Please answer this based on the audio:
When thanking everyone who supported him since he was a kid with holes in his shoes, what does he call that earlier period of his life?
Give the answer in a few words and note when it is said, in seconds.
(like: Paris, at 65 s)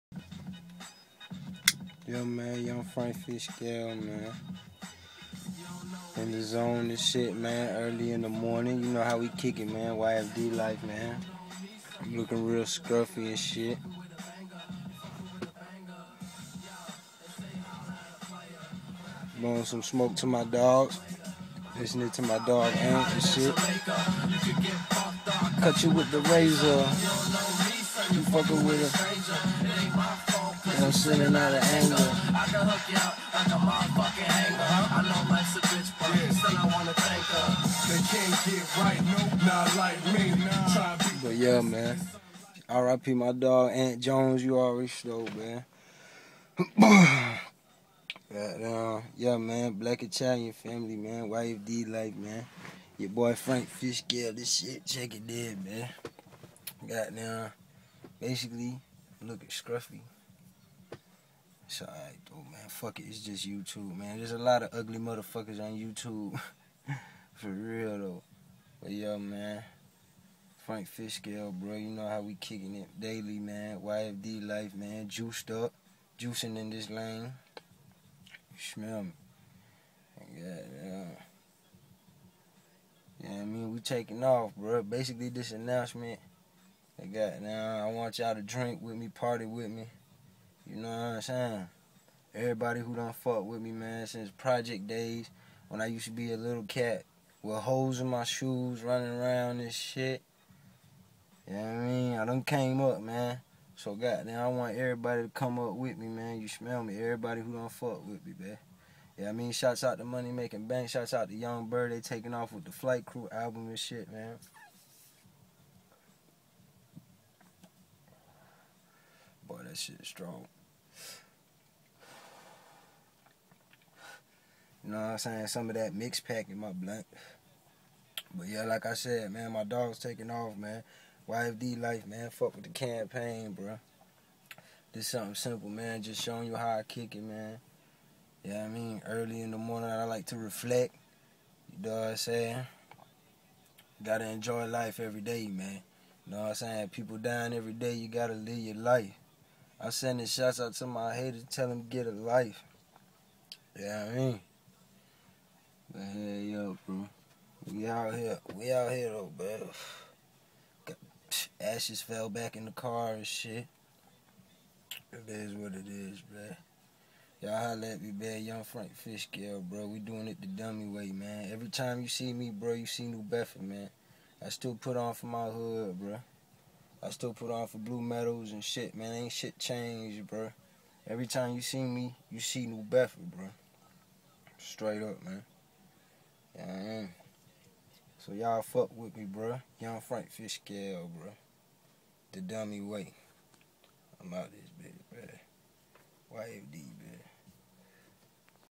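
project days, at 94 s.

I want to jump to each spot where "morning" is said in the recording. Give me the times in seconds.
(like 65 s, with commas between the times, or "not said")
8 s, 139 s.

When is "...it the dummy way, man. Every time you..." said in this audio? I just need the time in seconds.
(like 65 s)
170 s.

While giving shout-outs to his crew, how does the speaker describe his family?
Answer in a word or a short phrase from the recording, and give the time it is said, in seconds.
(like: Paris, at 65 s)
Black Italian, at 49 s.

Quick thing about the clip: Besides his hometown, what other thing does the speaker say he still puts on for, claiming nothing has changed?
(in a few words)
blue medals.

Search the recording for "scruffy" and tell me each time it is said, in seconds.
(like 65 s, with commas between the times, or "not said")
12 s, 59 s.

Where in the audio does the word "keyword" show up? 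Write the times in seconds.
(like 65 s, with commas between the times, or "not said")
not said.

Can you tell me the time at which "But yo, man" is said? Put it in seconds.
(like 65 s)
68 s.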